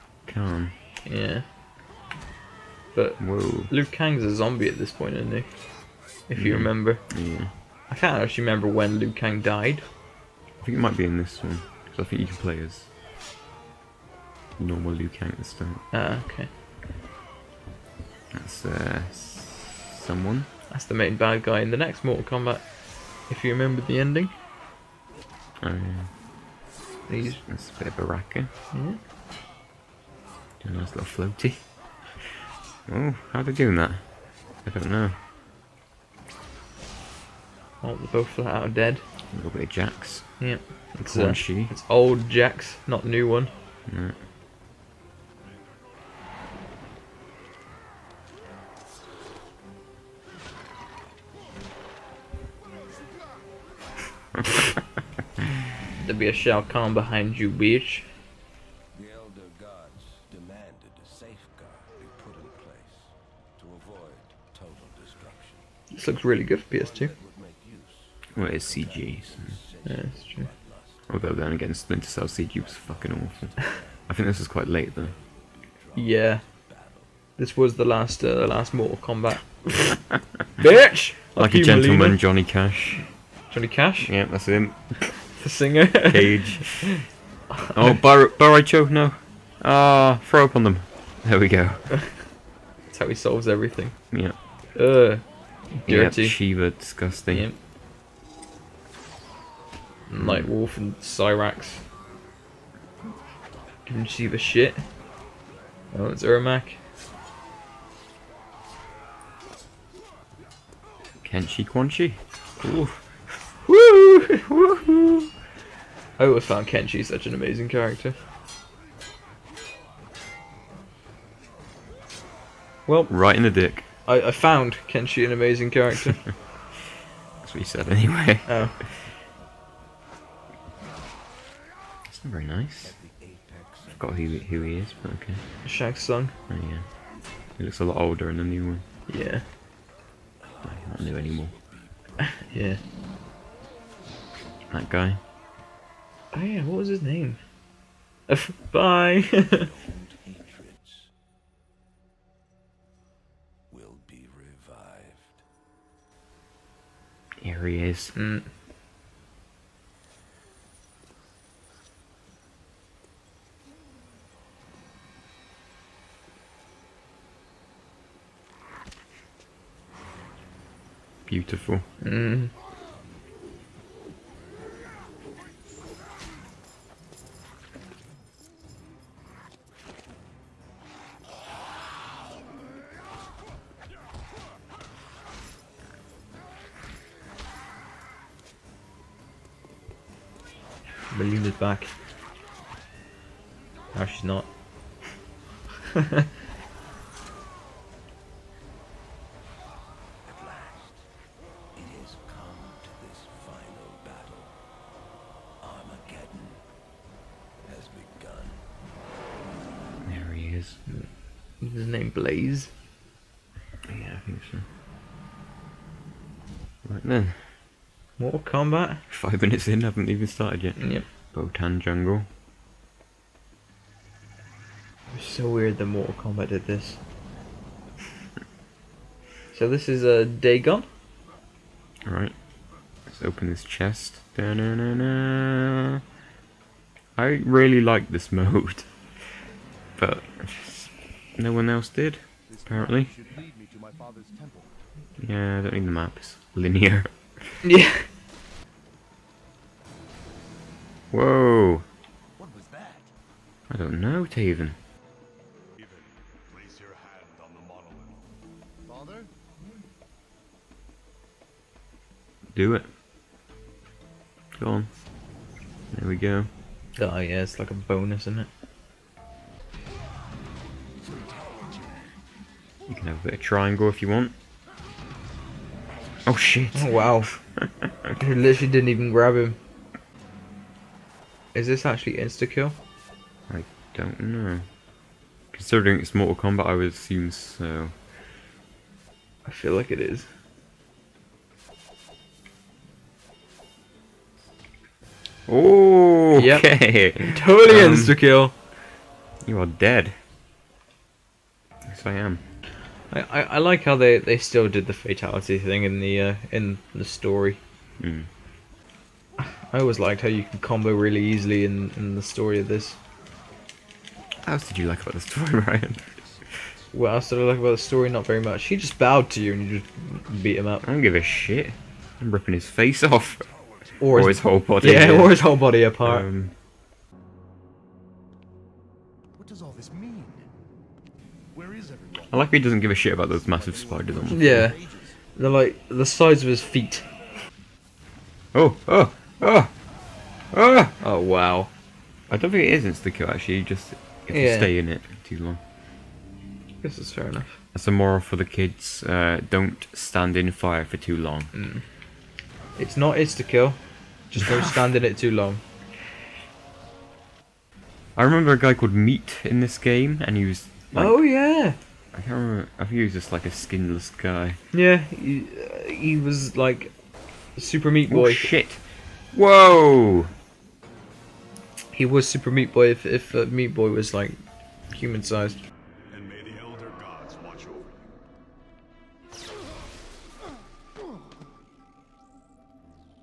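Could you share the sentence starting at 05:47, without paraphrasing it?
That's a moral for the kids.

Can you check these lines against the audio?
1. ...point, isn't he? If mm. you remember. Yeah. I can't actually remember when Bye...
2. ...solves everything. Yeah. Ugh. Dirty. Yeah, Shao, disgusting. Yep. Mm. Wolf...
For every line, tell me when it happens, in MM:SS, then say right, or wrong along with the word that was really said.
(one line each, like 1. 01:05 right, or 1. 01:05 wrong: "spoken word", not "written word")
1. 00:04 wrong: "Liu", not "Bye"
2. 01:33 wrong: "Sheeva", not "Shao".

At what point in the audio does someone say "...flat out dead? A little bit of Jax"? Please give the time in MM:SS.
00:38.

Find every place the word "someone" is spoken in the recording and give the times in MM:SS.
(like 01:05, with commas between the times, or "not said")
00:19.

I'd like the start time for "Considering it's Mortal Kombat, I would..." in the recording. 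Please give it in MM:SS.
04:45.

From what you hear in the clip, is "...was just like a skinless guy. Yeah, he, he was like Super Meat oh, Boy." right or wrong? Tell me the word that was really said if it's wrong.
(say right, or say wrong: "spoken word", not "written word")
right.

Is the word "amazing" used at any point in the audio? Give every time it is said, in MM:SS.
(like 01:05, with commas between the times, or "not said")
01:57, 02:05.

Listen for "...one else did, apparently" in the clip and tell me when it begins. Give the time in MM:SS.
04:01.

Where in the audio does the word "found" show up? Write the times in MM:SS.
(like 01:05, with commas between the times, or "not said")
01:56, 02:04.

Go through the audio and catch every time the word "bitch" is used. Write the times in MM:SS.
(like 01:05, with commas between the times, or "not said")
00:57, 01:20.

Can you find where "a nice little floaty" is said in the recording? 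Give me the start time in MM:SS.
00:30.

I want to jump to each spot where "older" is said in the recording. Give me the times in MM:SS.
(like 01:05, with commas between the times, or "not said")
02:17.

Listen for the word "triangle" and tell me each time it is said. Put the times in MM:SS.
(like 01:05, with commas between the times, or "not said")
04:33.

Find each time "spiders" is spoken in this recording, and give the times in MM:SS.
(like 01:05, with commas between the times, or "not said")
05:33.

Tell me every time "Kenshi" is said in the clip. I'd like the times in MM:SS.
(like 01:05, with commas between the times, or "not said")
01:51, 01:56, 02:04.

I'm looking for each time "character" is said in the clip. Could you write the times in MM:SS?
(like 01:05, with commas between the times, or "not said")
01:57, 02:05.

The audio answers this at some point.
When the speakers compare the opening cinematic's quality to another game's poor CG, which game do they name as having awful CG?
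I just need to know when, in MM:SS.
01:11.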